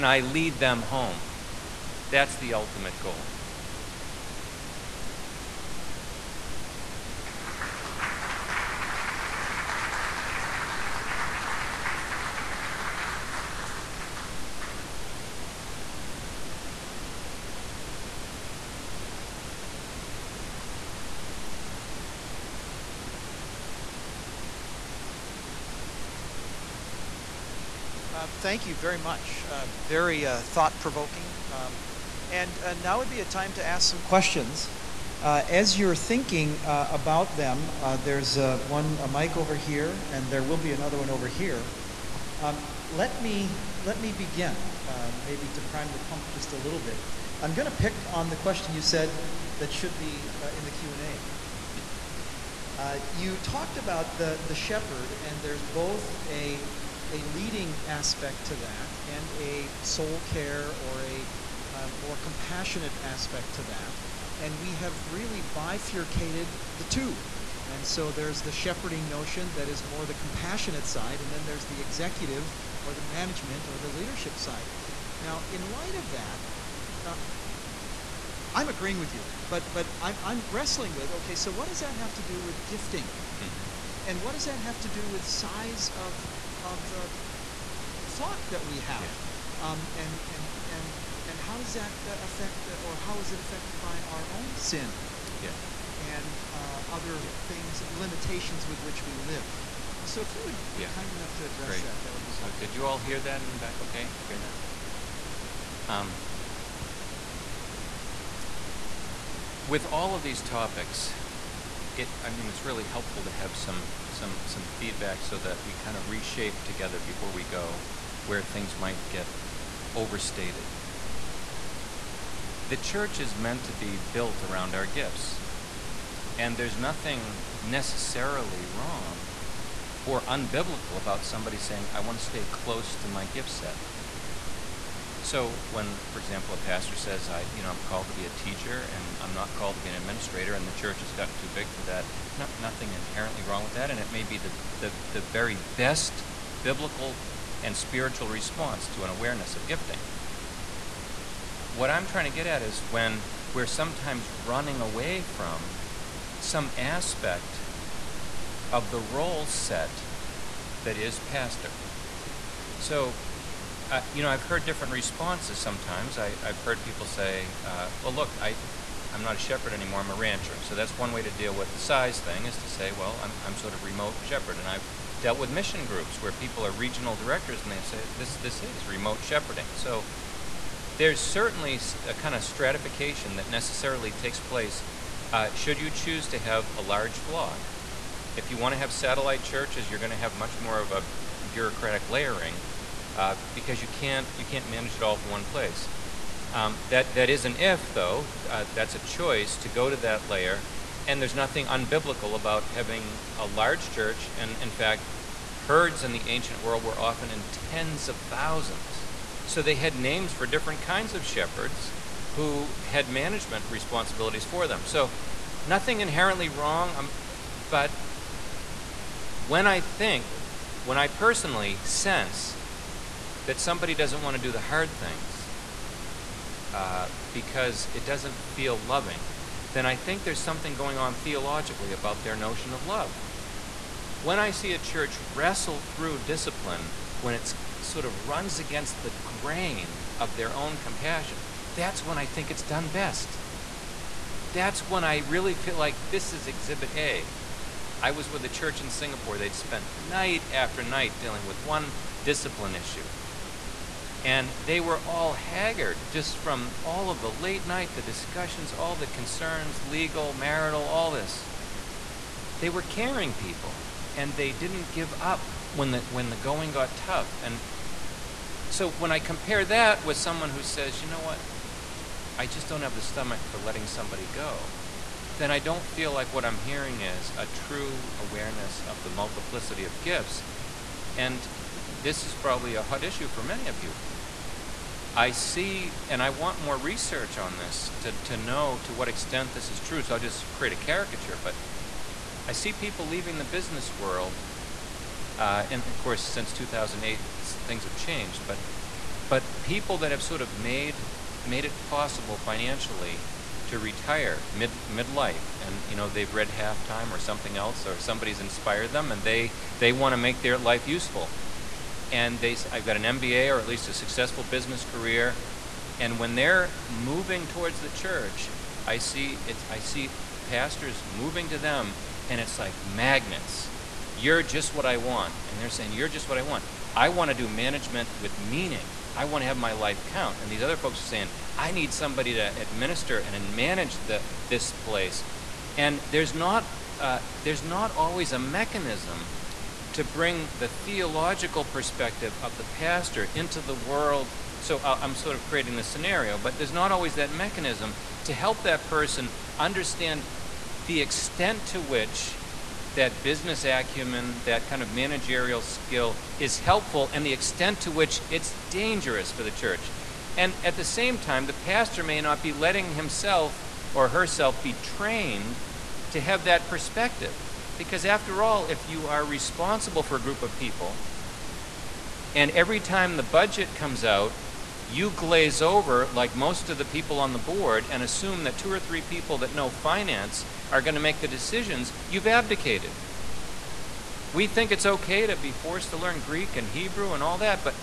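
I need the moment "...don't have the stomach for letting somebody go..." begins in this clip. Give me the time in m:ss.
4:32.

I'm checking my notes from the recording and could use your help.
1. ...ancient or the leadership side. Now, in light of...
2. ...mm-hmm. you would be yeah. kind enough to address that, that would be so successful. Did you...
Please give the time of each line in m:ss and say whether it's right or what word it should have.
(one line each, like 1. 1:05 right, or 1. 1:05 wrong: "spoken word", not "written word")
1. 1:13 wrong: "management", not "ancient"
2. 1:40 wrong: "helpful", not "successful".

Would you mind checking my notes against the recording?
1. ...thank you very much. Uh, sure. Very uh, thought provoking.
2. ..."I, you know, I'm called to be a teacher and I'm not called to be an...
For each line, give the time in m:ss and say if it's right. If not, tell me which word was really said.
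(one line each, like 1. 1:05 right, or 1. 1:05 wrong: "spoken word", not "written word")
1. 0:28 right
2. 2:17 right.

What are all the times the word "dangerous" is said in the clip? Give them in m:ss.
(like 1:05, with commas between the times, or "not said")
5:58.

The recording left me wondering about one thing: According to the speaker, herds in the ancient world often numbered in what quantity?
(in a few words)
Tens of thousands.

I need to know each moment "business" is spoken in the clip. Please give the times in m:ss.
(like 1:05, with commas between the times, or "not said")
4:53, 5:14, 5:53.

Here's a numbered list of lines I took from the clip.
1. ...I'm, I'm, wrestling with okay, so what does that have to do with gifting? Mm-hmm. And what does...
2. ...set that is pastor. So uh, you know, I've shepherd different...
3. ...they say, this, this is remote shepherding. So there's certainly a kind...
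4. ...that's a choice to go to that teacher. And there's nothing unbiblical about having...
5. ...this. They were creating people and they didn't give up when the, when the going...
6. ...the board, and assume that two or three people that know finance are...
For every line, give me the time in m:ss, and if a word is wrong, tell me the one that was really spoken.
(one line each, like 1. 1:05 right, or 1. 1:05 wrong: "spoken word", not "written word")
1. 1:19 right
2. 2:39 wrong: "heard", not "shepherd"
3. 2:57 right
4. 3:18 wrong: "layer", not "teacher"
5. 4:21 wrong: "caring", not "creating"
6. 6:17 right.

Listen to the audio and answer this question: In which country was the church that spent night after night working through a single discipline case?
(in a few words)
Singapore.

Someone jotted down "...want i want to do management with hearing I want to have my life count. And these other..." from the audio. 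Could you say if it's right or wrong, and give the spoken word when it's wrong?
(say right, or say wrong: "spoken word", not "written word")
wrong: "meaning", not "hearing".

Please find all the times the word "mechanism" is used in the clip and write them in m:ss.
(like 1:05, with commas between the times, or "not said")
5:38, 5:47.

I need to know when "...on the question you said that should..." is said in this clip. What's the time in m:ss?
0:48.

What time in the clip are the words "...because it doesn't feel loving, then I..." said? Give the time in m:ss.
3:47.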